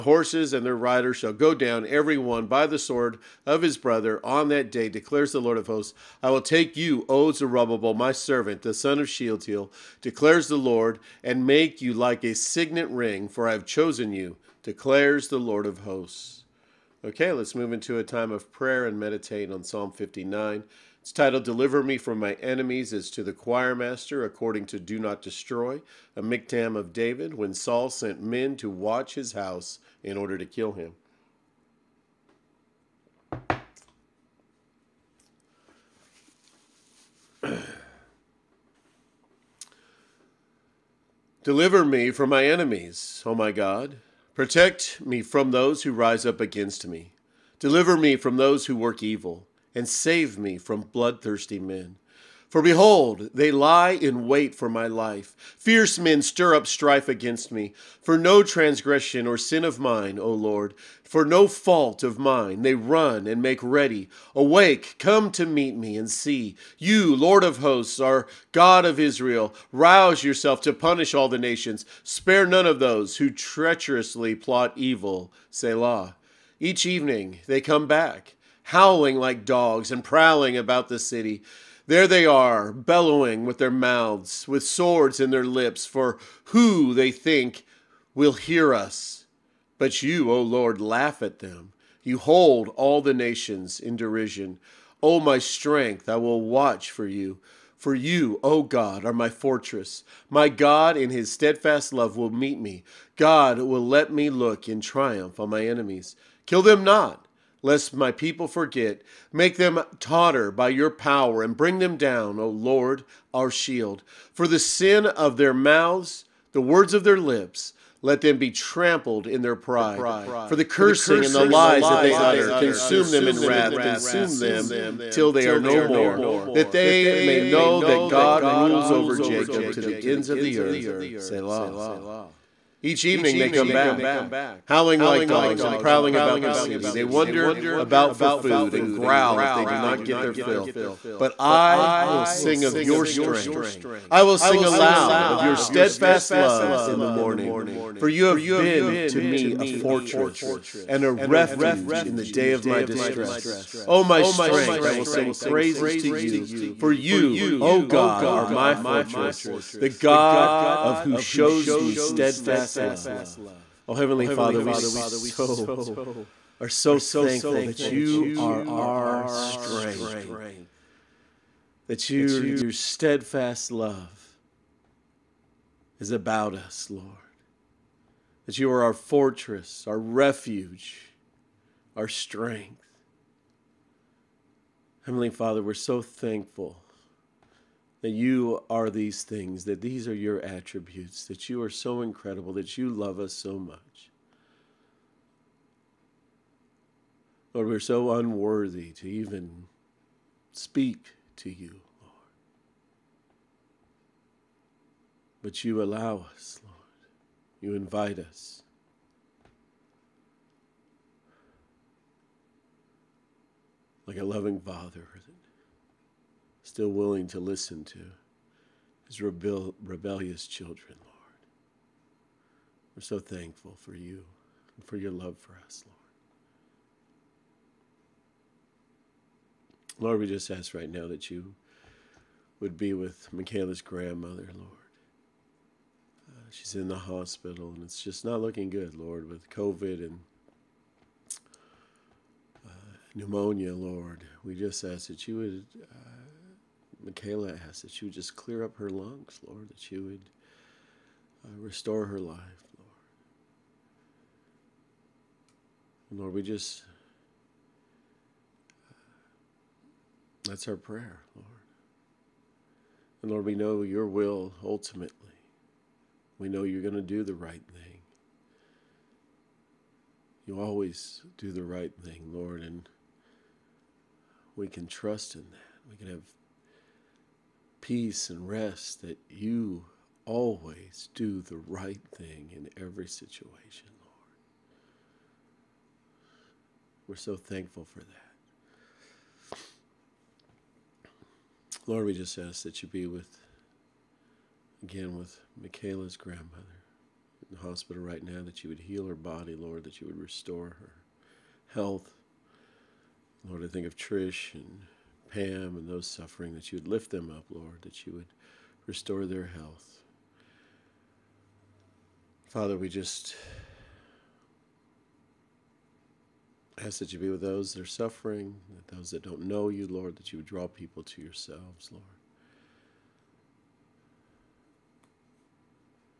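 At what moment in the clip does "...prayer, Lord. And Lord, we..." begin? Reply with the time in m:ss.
4:20.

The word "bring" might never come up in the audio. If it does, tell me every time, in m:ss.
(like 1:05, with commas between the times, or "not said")
1:51.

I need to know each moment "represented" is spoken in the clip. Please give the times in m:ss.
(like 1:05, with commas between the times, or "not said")
not said.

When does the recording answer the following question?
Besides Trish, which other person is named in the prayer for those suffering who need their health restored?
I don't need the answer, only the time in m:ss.
5:05.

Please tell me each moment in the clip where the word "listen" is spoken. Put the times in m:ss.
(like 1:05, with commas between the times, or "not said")
3:37.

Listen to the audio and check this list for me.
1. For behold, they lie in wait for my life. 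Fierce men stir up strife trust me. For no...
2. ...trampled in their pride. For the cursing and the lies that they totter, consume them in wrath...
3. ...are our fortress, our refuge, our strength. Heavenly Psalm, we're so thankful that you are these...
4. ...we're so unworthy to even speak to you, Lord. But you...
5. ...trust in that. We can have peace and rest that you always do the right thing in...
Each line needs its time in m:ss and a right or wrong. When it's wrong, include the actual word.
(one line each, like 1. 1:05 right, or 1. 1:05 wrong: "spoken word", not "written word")
1. 0:52 wrong: "against", not "trust"
2. 1:58 wrong: "utter", not "totter"
3. 2:58 wrong: "Father", not "Psalm"
4. 3:17 right
5. 4:34 right.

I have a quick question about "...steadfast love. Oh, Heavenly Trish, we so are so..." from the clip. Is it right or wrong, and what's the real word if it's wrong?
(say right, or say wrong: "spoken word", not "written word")
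wrong: "Father", not "Trish".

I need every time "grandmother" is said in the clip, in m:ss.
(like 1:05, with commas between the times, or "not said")
3:53, 4:56.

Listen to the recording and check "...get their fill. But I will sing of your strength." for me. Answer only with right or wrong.
right.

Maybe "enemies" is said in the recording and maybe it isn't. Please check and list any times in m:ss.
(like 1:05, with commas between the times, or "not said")
0:22, 0:42, 1:45.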